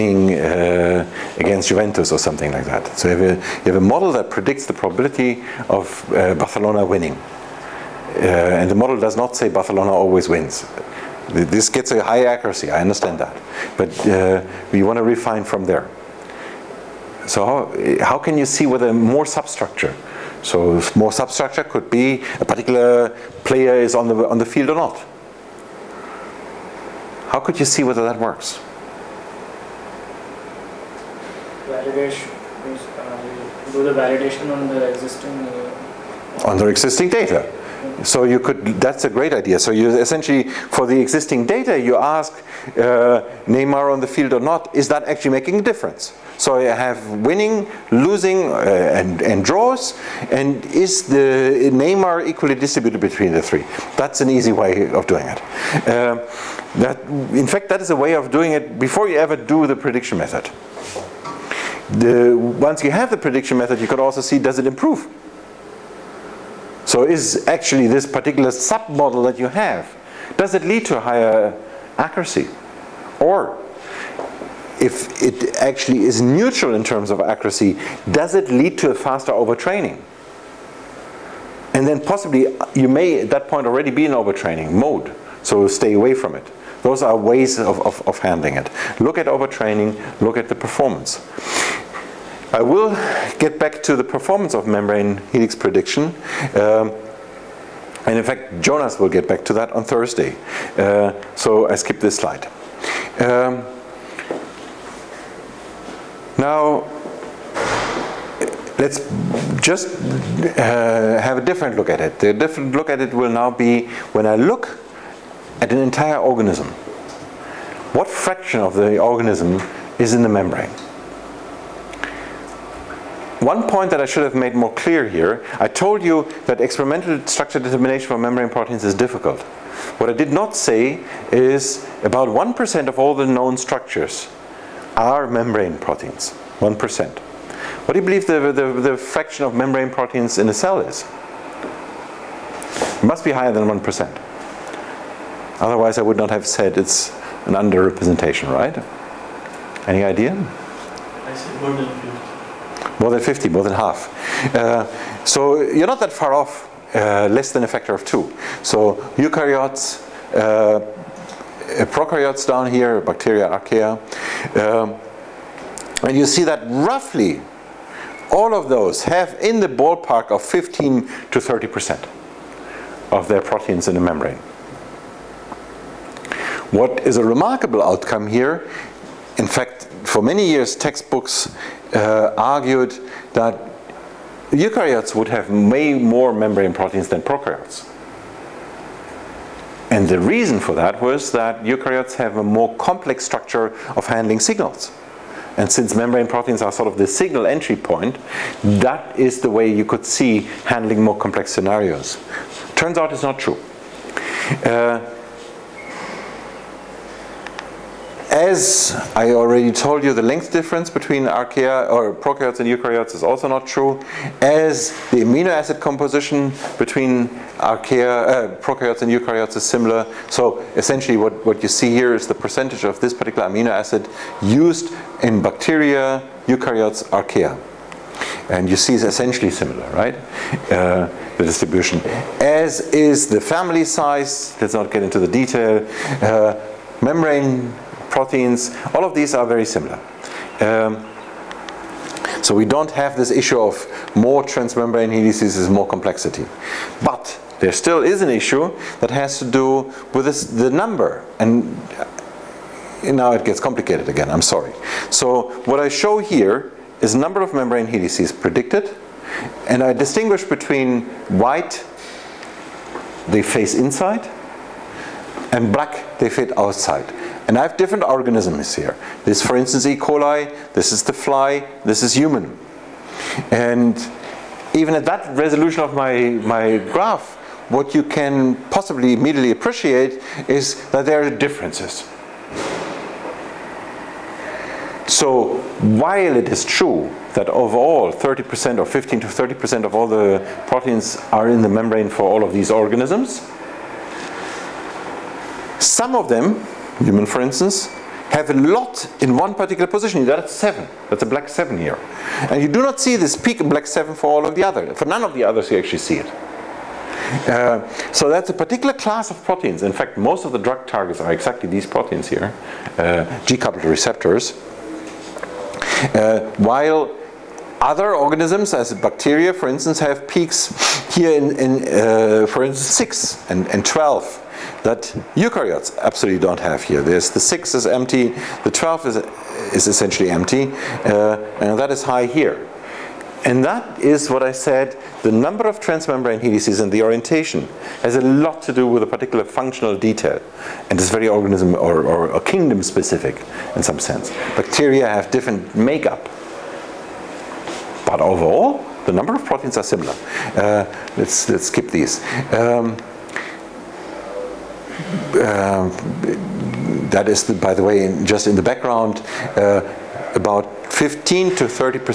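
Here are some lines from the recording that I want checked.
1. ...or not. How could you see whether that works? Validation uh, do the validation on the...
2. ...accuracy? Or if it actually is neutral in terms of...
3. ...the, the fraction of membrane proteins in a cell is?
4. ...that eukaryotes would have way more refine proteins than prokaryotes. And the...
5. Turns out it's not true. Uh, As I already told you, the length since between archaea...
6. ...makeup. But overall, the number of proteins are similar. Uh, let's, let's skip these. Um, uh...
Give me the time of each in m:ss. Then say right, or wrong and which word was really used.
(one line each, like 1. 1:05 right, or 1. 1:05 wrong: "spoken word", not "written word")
1. 0:24 right
2. 1:11 right
3. 2:18 right
4. 3:03 wrong: "membrane", not "refine"
5. 3:22 wrong: "difference", not "since"
6. 5:45 right.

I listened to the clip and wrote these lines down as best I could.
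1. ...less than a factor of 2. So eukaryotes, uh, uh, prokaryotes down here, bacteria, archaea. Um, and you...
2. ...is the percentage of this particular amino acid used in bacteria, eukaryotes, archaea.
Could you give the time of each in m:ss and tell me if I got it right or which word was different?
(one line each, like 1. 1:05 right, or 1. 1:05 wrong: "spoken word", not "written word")
1. 2:37 right
2. 3:42 right.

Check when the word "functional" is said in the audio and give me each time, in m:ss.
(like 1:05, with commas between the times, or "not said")
5:39.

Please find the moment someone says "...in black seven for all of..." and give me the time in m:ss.
5:03.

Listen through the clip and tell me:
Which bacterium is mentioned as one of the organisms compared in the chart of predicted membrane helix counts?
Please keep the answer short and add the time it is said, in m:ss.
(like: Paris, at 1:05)
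E. coli, at 4:29.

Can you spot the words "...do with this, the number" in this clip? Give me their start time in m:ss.
4:09.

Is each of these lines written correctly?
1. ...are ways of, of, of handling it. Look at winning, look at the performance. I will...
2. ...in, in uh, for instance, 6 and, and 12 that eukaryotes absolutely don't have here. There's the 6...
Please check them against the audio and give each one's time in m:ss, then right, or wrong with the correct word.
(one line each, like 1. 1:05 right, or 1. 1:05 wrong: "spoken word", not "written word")
1. 1:27 wrong: "overtraining", not "winning"
2. 5:21 right.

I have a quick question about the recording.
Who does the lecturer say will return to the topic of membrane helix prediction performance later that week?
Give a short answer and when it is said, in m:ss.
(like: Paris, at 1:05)
Jonas, at 1:38.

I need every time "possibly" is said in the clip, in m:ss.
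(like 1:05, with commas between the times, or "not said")
1:21, 4:38.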